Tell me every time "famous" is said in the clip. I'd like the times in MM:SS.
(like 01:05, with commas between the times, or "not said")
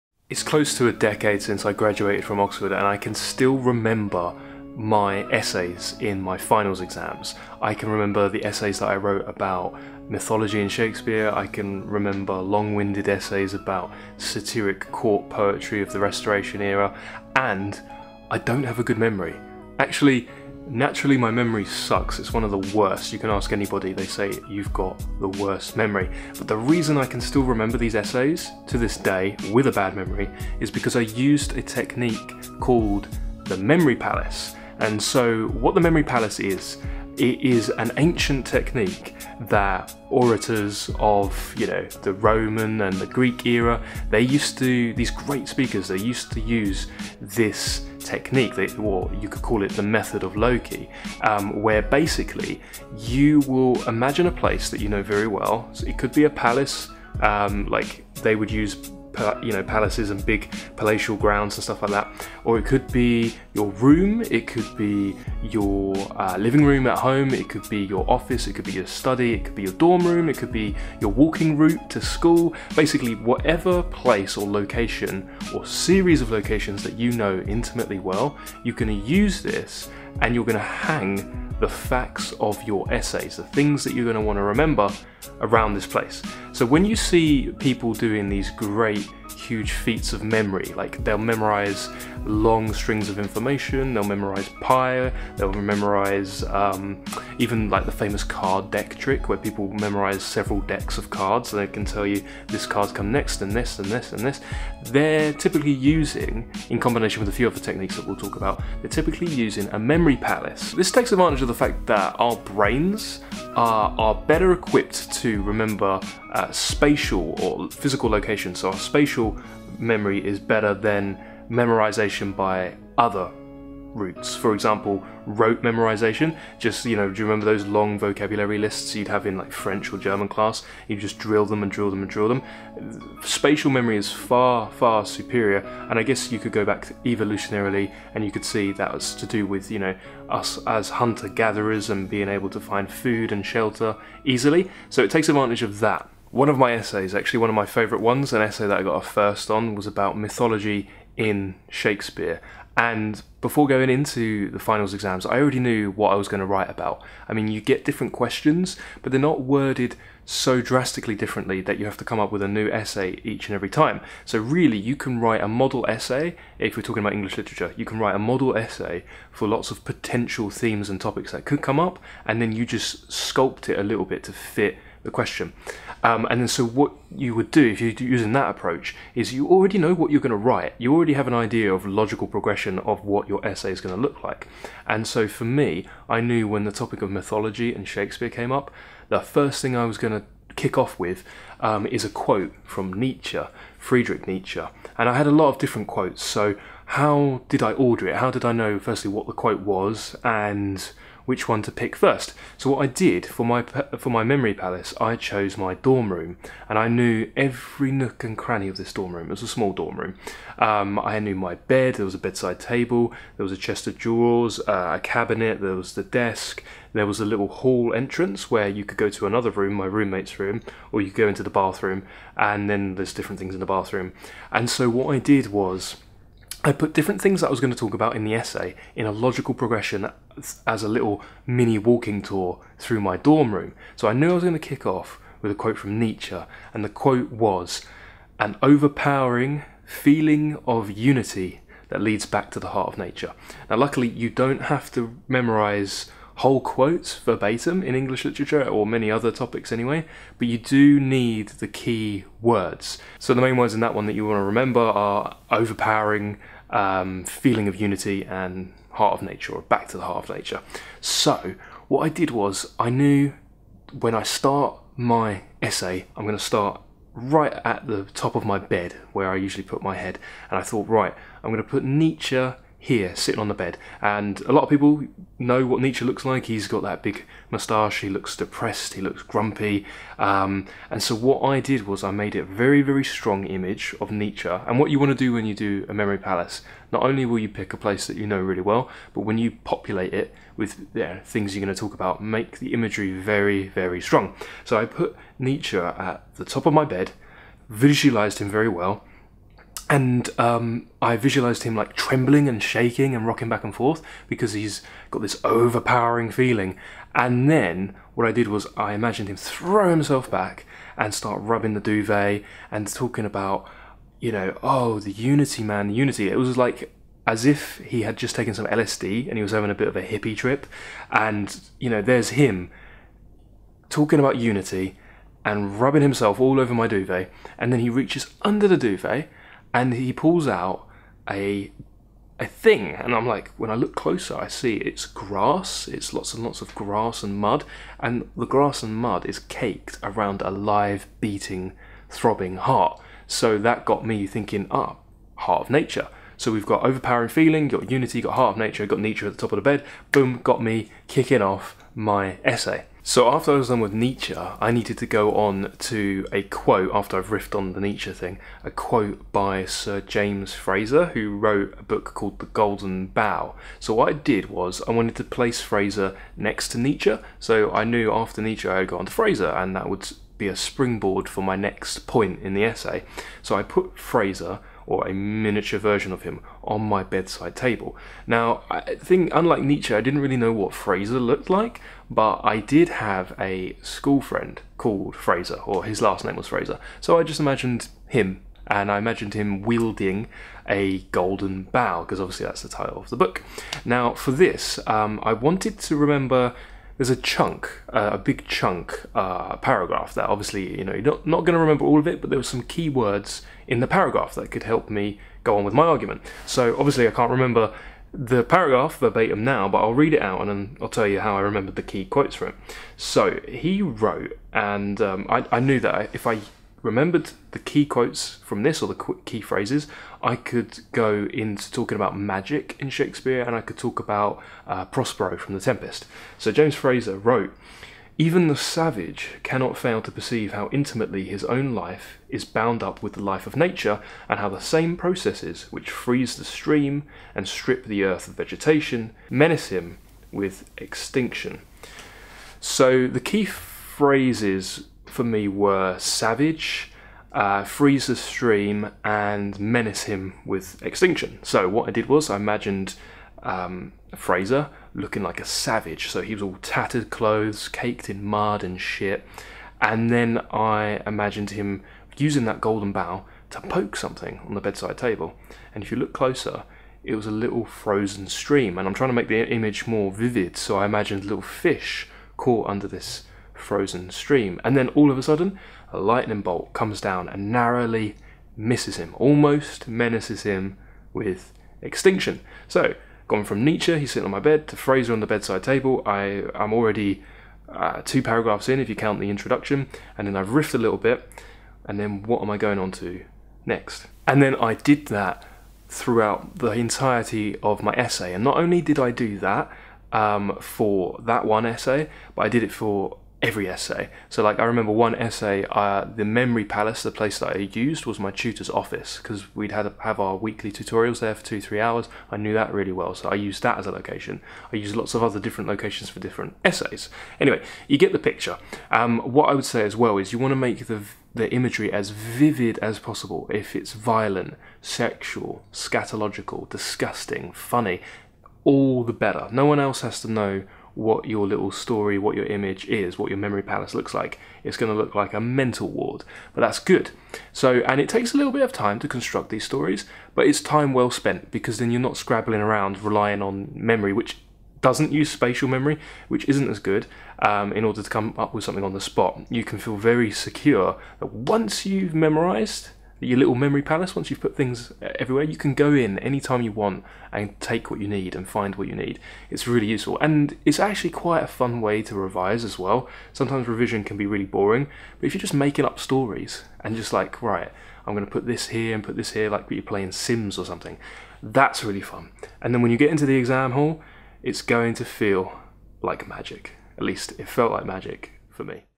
01:37.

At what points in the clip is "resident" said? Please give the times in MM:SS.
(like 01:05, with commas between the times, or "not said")
not said.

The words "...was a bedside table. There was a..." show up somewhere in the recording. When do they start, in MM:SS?
03:32.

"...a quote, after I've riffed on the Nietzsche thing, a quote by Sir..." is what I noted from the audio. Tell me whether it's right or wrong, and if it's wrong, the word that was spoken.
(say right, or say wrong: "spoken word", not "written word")
right.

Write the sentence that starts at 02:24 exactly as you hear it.
So it takes advantage of that.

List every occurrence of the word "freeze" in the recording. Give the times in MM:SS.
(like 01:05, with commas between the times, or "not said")
07:15, 07:27.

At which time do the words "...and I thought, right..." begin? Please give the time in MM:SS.
04:30.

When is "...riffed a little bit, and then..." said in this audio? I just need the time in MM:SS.
08:10.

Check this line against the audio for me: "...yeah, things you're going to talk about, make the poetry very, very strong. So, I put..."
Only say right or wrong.
wrong.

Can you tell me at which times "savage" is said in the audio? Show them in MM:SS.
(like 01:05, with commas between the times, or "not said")
07:08, 07:25, 07:35.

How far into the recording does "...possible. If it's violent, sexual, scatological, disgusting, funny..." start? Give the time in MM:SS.
08:42.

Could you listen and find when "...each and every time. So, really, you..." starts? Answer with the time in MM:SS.
02:43.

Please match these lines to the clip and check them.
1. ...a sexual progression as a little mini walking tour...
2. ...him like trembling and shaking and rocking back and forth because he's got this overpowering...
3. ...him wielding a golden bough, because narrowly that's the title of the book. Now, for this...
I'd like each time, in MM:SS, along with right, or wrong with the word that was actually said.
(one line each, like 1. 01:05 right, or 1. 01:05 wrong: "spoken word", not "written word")
1. 03:49 wrong: "logical", not "sexual"
2. 05:01 right
3. 06:29 wrong: "obviously", not "narrowly".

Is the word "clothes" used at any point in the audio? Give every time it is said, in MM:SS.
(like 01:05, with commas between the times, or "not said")
07:37.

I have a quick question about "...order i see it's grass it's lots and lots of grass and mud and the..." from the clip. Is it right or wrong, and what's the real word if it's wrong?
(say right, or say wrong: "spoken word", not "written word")
wrong: "closer", not "order".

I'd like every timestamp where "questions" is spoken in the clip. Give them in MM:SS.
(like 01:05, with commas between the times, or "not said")
02:38, 02:55.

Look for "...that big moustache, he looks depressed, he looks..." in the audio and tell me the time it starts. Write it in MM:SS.
04:36.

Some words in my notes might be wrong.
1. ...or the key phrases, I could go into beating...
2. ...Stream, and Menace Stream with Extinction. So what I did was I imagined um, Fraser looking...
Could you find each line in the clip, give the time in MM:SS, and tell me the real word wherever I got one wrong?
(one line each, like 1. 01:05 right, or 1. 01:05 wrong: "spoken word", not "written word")
1. 06:58 wrong: "talking", not "beating"
2. 07:28 wrong: "Him", not "Stream".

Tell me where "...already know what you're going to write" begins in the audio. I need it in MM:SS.
02:59.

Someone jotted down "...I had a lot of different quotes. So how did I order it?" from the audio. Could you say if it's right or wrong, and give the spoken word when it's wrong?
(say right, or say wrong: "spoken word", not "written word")
right.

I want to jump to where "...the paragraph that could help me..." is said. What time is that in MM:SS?
06:43.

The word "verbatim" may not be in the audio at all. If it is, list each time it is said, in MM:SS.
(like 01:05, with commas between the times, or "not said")
04:07, 06:48.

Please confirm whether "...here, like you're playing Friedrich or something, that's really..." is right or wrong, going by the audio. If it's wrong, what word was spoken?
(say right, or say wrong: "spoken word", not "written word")
wrong: "Sims", not "Friedrich".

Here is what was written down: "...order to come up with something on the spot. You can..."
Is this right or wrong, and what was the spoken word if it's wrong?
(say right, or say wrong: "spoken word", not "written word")
right.